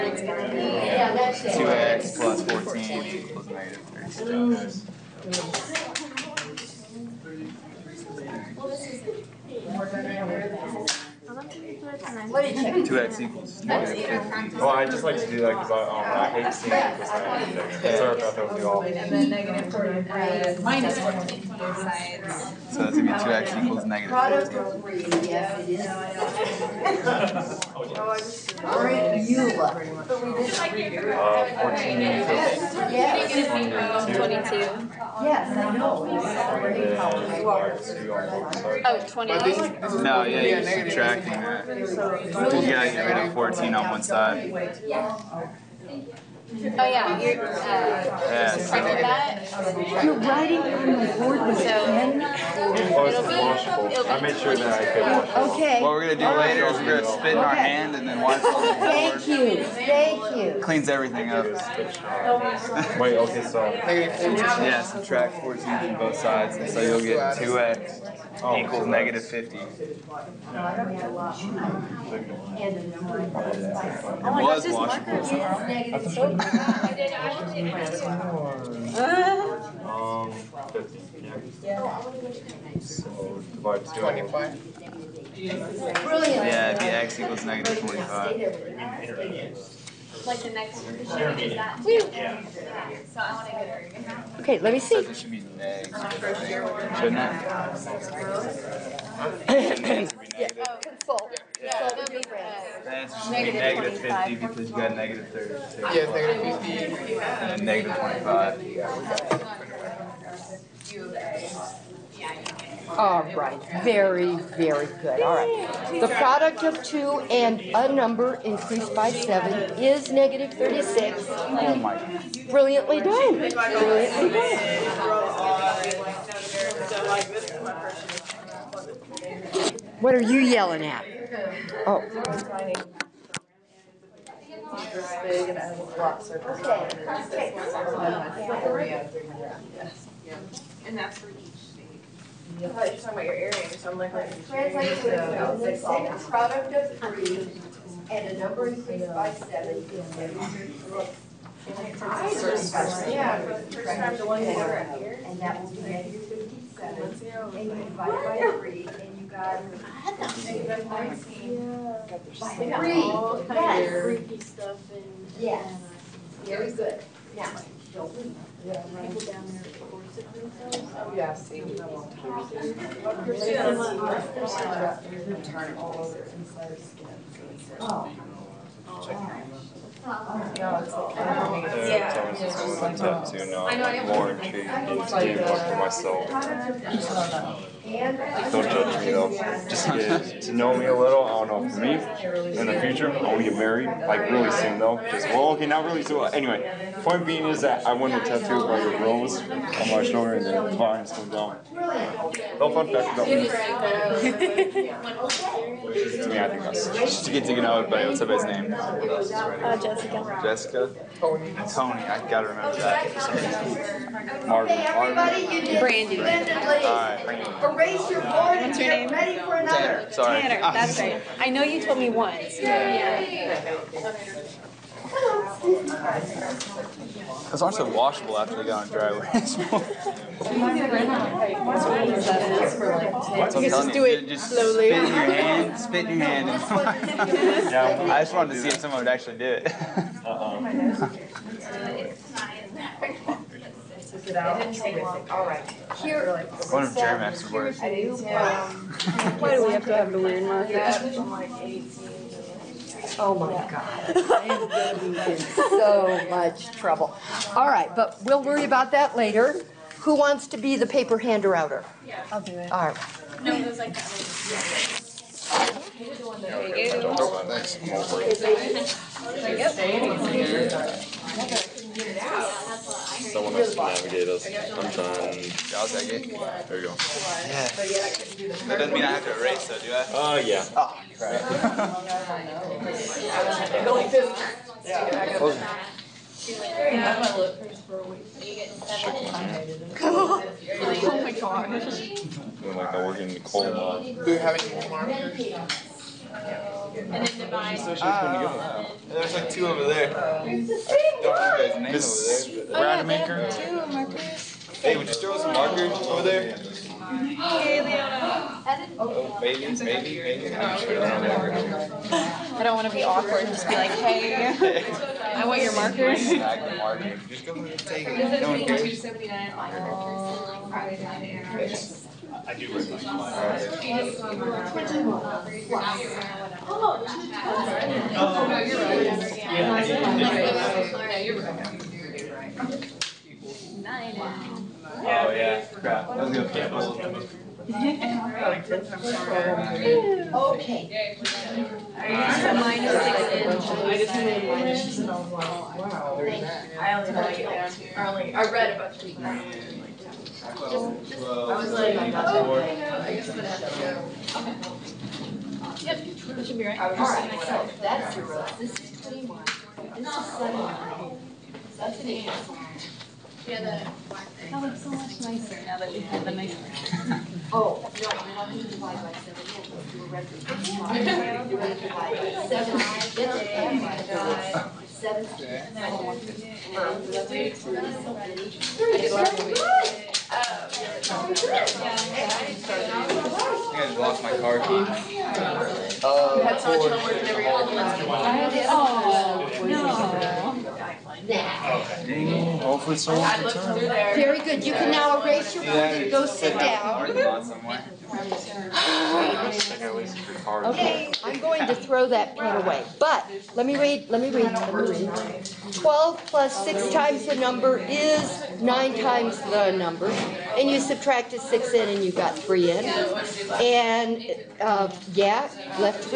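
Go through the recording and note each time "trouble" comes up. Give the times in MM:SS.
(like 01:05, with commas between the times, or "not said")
04:16.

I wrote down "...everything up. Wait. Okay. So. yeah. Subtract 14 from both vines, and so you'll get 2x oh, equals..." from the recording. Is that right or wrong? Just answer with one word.
wrong.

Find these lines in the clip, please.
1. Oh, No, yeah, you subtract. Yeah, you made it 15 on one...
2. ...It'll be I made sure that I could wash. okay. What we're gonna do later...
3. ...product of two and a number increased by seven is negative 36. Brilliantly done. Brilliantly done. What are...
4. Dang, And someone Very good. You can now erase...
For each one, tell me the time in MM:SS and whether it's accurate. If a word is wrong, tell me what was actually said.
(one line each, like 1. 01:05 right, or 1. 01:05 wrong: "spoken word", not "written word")
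1. 00:39 wrong: "14", not "15"
2. 00:52 right
3. 01:56 right
4. 06:31 wrong: "Hopefully", not "And".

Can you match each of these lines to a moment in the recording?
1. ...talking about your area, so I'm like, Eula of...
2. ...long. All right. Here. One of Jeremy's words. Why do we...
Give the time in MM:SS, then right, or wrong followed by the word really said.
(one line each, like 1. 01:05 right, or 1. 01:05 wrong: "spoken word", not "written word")
1. 02:22 wrong: "Translation", not "Eula"
2. 04:05 right.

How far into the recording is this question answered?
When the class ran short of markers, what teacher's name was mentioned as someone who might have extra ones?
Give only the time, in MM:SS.
05:03.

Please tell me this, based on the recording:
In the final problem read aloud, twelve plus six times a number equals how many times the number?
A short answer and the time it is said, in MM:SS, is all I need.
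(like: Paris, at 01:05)
9, at 06:48.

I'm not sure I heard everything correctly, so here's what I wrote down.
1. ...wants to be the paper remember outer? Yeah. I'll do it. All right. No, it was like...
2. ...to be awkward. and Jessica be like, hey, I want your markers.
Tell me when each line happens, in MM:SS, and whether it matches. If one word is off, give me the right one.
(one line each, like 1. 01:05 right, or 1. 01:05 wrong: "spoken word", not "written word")
1. 04:20 wrong: "hander", not "remember"
2. 05:12 wrong: "Just", not "Jessica".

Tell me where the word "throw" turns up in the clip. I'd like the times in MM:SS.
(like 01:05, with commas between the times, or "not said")
05:05, 06:41.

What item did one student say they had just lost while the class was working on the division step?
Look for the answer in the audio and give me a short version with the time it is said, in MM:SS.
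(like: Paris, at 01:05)
Car keys, at 06:24.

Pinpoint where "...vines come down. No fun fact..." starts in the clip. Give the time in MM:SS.
03:20.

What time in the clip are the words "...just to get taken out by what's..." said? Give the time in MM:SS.
03:26.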